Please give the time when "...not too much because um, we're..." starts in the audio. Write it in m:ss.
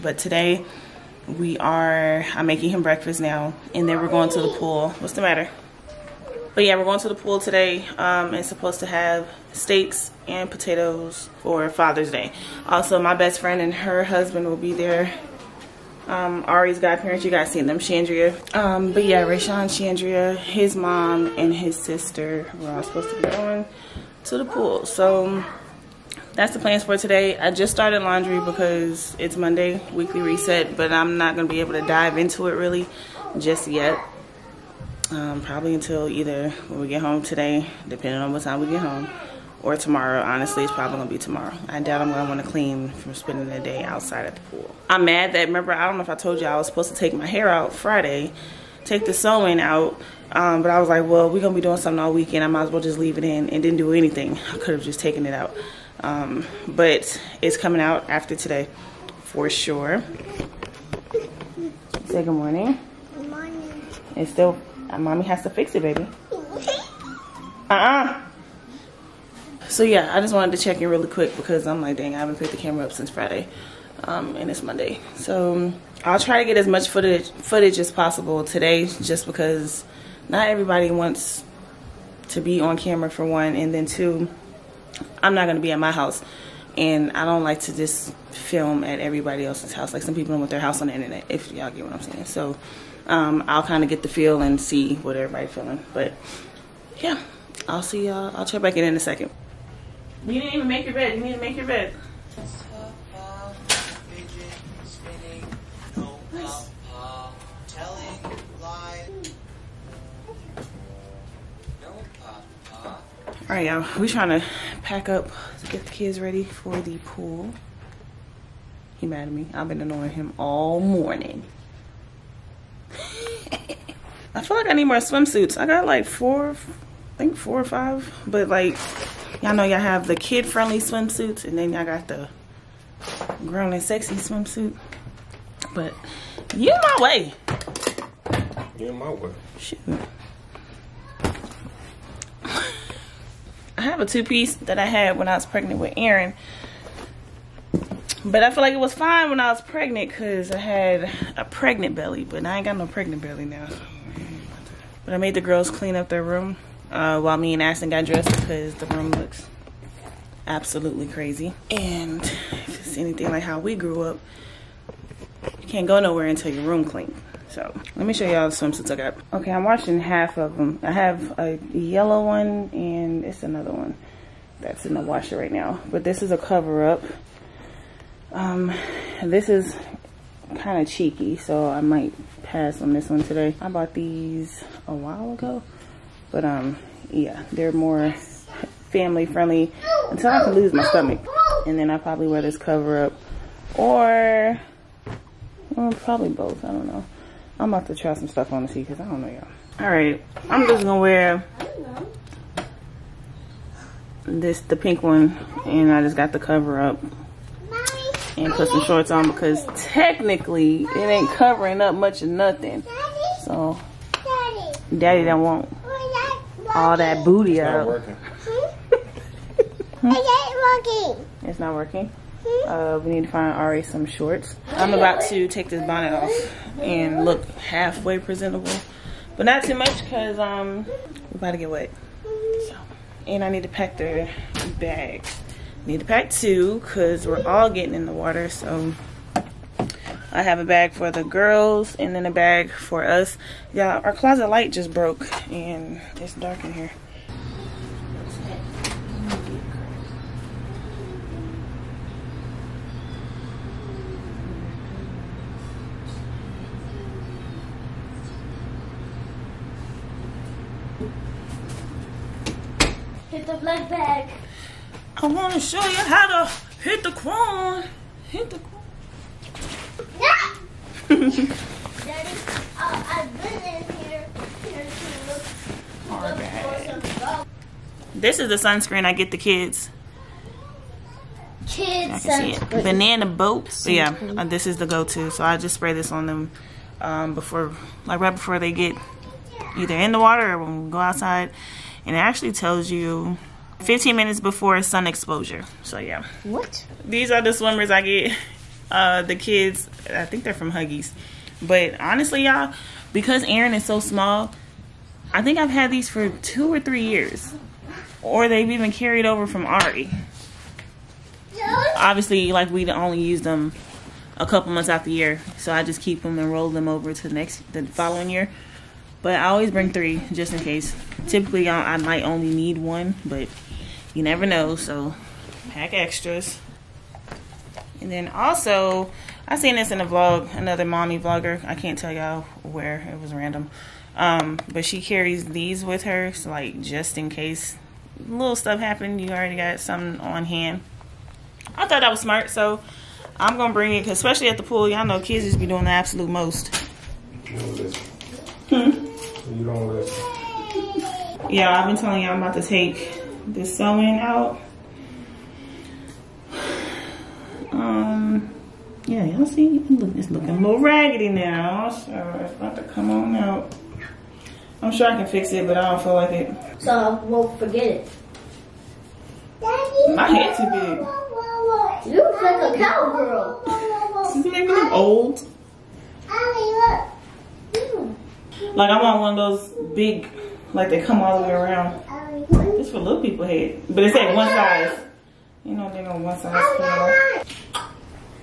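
3:49.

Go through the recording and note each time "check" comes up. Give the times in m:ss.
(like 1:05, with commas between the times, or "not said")
1:10, 1:38.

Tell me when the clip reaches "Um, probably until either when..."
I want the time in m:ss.
0:35.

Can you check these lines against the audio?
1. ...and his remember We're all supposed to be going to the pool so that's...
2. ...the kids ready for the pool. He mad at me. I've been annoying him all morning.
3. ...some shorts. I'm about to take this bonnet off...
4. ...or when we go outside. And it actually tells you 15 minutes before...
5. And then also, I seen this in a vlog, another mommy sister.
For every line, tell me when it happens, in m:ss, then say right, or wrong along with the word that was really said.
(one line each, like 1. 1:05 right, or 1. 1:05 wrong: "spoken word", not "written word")
1. 0:21 wrong: "sister", not "remember"
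2. 1:55 right
3. 3:43 right
4. 4:50 right
5. 5:28 wrong: "vlogger", not "sister".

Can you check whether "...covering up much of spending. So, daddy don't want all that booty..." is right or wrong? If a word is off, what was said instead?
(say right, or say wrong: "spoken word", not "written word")
wrong: "nothing", not "spending".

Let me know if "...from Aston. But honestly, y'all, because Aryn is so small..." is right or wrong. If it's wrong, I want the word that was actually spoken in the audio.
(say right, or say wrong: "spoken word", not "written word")
wrong: "Huggies", not "Aston".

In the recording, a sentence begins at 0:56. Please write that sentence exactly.
Um, but it's coming out after today for sure.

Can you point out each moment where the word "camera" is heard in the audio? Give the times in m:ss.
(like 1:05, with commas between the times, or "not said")
1:12, 1:22.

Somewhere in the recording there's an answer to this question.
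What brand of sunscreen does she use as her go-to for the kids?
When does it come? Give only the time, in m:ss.
4:42.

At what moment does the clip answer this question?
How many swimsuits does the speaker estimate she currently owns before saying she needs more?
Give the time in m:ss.
2:07.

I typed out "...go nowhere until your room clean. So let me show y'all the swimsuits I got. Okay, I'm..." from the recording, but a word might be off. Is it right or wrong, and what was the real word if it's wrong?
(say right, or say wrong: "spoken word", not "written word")
right.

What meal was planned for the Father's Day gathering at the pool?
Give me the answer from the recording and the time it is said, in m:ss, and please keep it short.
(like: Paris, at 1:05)
Steaks and potatoes, at 0:09.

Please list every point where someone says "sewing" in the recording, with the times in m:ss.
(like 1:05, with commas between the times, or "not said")
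0:49, 5:53.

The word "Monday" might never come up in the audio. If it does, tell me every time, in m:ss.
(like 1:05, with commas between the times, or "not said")
0:29, 1:14.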